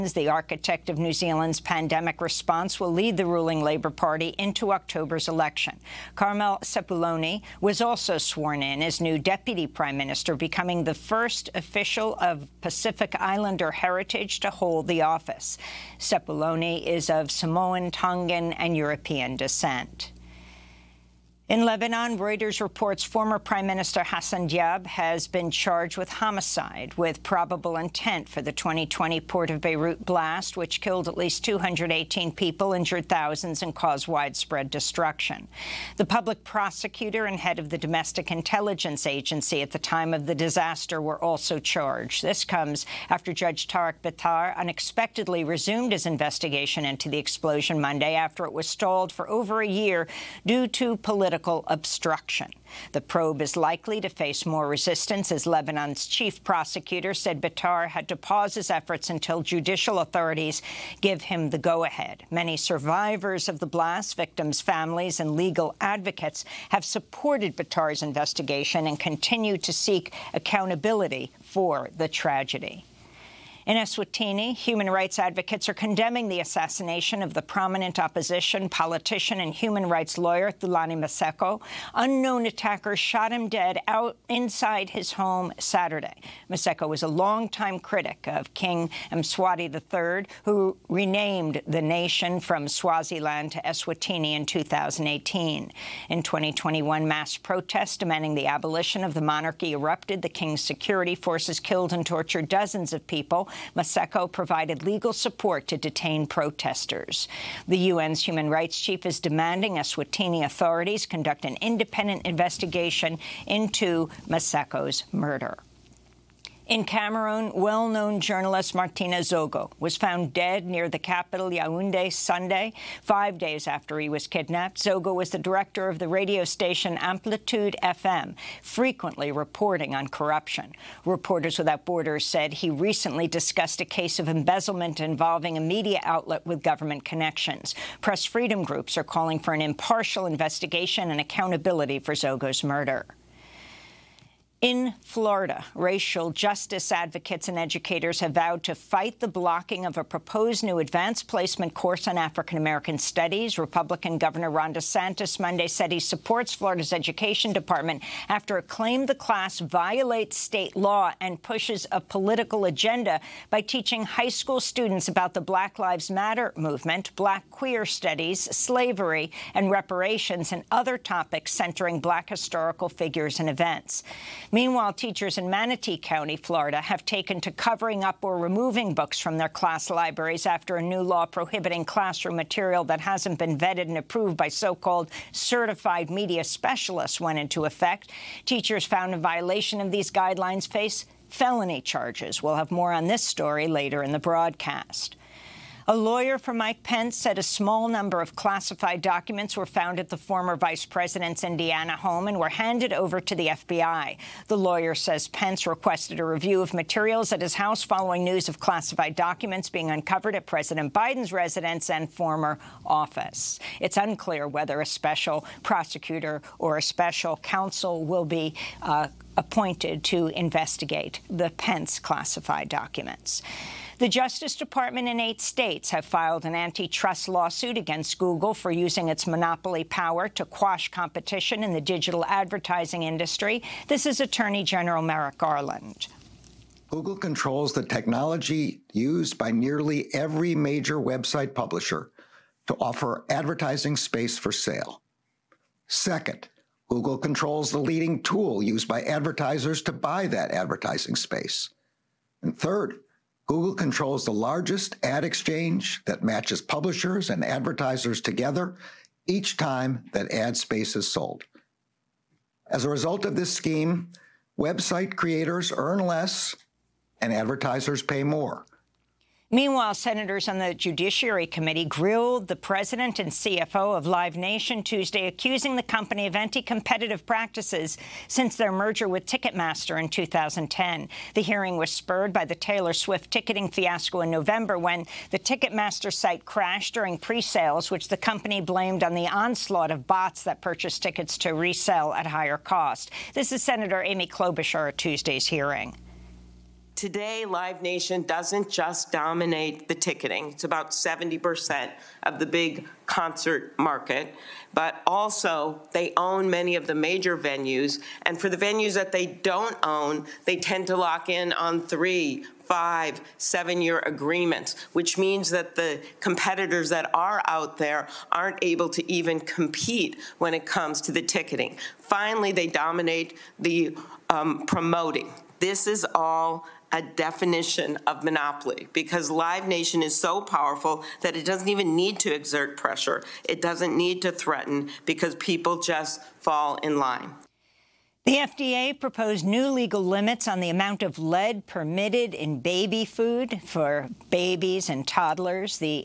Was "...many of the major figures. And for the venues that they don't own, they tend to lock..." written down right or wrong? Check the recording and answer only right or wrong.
wrong.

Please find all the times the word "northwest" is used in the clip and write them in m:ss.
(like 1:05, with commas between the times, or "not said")
not said.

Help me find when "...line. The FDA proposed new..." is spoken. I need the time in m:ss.
5:36.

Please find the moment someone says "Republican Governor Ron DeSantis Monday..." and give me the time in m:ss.
2:33.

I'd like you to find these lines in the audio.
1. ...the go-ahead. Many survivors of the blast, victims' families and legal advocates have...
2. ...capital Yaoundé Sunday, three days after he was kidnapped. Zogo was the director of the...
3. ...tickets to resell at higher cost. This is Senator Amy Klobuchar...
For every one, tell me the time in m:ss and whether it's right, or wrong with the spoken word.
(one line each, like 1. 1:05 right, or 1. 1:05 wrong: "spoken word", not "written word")
1. 1:01 right
2. 2:00 wrong: "five", not "three"
3. 4:51 right.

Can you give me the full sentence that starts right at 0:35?
The public prosecutor and head of the Domestic Intelligence Agency at the time of the disaster were also charged.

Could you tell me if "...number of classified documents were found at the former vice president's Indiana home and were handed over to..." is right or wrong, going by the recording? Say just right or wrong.
right.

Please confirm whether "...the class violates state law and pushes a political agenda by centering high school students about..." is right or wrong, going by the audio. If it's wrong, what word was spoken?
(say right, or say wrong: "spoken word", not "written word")
wrong: "teaching", not "centering".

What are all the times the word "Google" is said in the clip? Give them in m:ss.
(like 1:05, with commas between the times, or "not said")
3:48, 3:56, 4:06, 4:13.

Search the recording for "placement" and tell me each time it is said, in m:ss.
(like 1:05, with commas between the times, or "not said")
2:31.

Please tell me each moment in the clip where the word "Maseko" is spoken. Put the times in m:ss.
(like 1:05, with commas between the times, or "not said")
1:20, 1:26, 1:43, 1:54.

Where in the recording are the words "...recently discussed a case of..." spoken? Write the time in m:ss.
2:12.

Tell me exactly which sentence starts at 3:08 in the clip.
Teachers found in violation of these guidelines face felony charges.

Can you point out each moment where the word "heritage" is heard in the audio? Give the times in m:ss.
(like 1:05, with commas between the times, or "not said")
0:13.